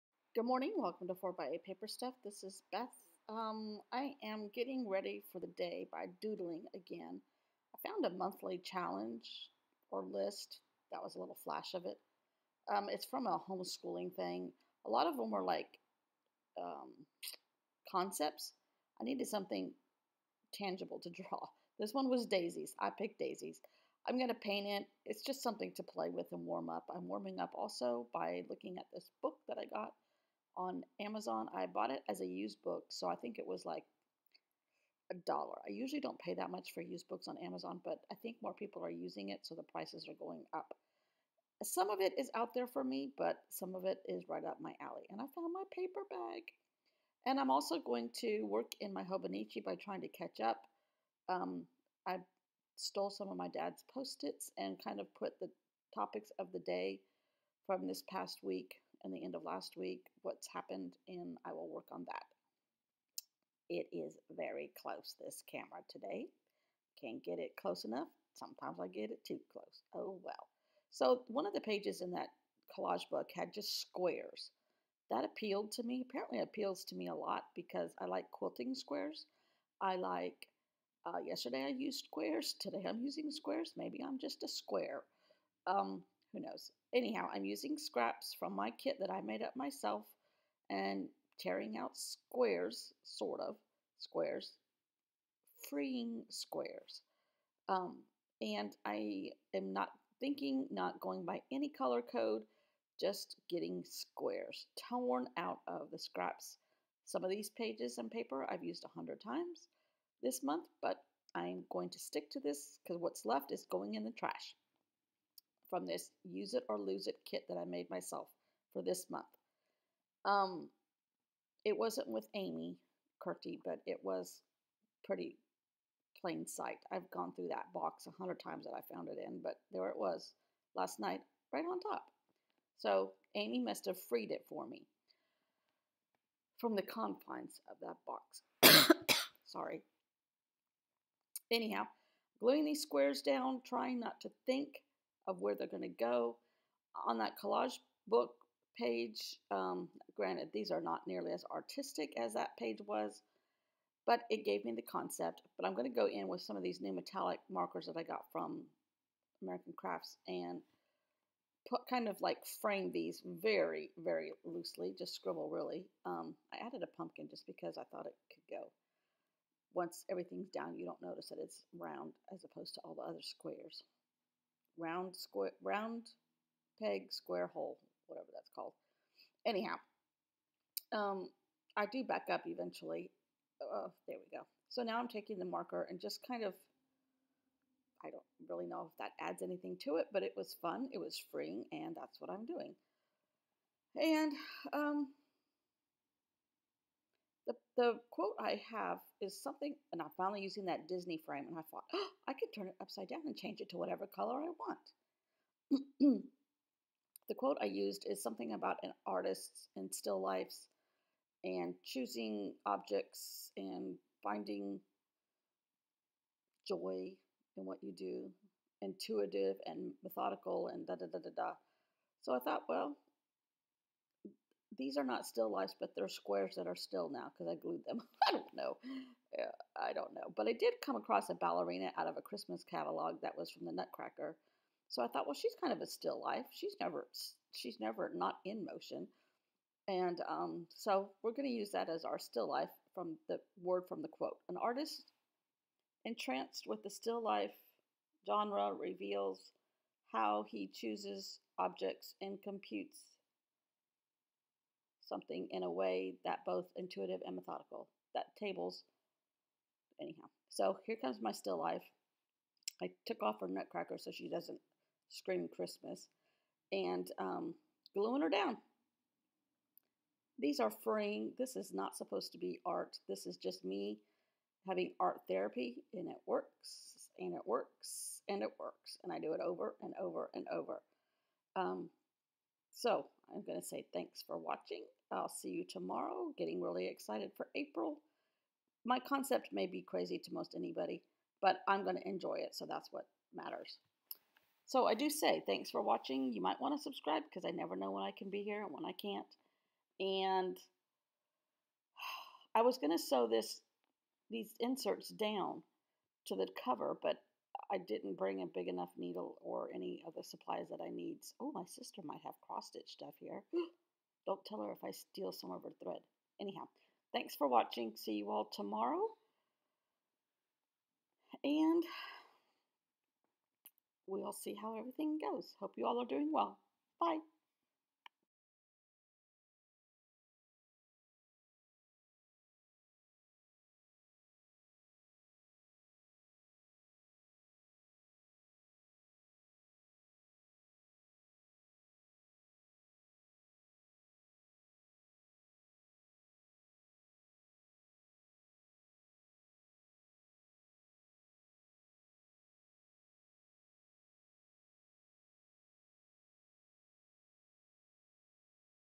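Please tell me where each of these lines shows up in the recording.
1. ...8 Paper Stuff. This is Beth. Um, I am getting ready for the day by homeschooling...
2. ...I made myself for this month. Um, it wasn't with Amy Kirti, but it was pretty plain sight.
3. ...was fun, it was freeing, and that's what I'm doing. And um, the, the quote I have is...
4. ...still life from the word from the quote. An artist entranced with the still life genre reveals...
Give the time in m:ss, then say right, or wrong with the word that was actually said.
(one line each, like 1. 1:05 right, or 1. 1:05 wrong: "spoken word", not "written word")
1. 0:01 wrong: "doodling", not "homeschooling"
2. 1:57 right
3. 3:10 right
4. 4:02 right.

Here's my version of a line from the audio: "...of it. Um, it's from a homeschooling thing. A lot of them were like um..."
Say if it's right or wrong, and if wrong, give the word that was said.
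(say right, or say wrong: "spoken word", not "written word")
right.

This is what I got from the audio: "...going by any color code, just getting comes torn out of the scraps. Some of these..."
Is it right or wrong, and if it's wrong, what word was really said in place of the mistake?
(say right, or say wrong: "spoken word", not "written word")
wrong: "squares", not "comes".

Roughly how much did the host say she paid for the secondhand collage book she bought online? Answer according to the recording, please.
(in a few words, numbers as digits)
$1.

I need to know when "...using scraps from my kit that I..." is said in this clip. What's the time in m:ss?
1:27.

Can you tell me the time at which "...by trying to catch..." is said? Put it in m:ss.
0:49.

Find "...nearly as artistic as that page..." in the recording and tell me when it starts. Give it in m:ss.
2:31.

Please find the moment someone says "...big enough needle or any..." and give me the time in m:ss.
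5:08.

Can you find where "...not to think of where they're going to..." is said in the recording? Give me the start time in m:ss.
2:23.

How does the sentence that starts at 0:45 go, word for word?
And I found my paper bag.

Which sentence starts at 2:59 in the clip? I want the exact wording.
Anyhow, um, I do back up eventually.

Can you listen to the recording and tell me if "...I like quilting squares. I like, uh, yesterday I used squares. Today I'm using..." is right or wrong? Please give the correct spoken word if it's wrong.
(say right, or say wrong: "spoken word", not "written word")
right.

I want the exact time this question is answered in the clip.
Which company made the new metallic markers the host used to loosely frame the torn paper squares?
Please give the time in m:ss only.
2:39.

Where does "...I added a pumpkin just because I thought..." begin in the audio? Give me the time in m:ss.
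2:46.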